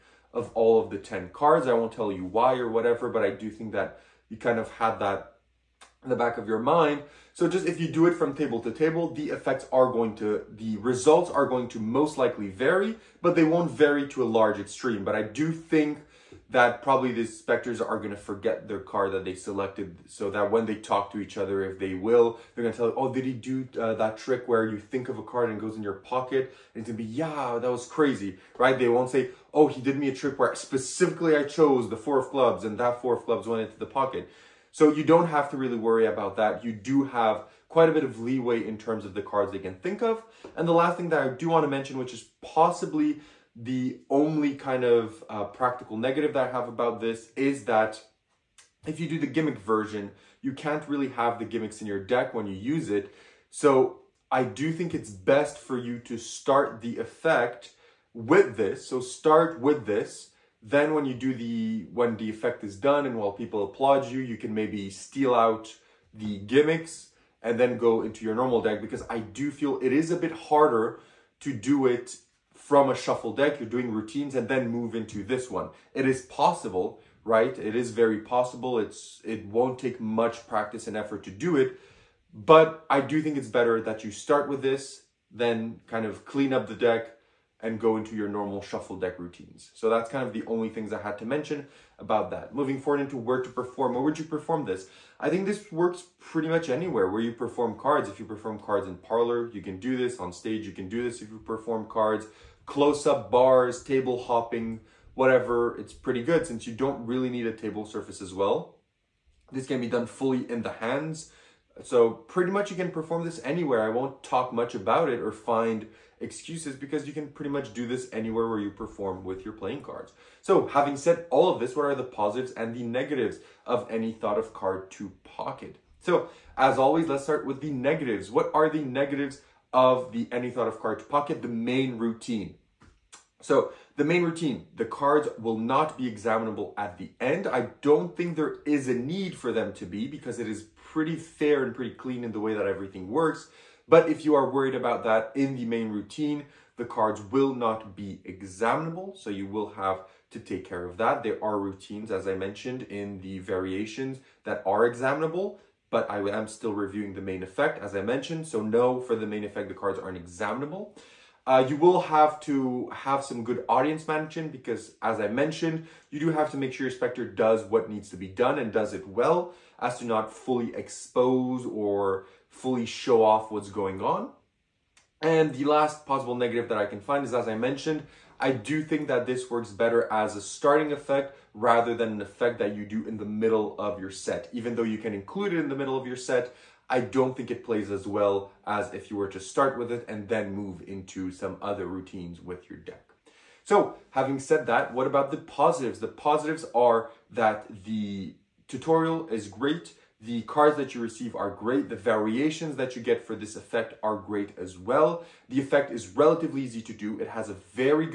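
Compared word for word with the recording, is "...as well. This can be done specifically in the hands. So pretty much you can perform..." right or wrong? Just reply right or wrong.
wrong.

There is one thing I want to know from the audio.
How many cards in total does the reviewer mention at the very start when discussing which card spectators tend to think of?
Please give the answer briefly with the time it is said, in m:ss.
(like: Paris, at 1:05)
10, at 0:00.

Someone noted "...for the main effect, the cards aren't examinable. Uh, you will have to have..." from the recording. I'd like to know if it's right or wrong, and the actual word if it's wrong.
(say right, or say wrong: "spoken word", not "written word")
right.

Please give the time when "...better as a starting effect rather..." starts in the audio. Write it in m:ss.
2:59.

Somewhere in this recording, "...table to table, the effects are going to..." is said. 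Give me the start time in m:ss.
0:08.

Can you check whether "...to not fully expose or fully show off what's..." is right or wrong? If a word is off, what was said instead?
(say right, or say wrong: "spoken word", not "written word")
right.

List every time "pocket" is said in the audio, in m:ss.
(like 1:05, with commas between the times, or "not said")
0:25, 0:33, 2:05, 2:11.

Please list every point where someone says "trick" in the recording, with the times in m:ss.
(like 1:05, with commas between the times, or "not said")
0:24, 0:30.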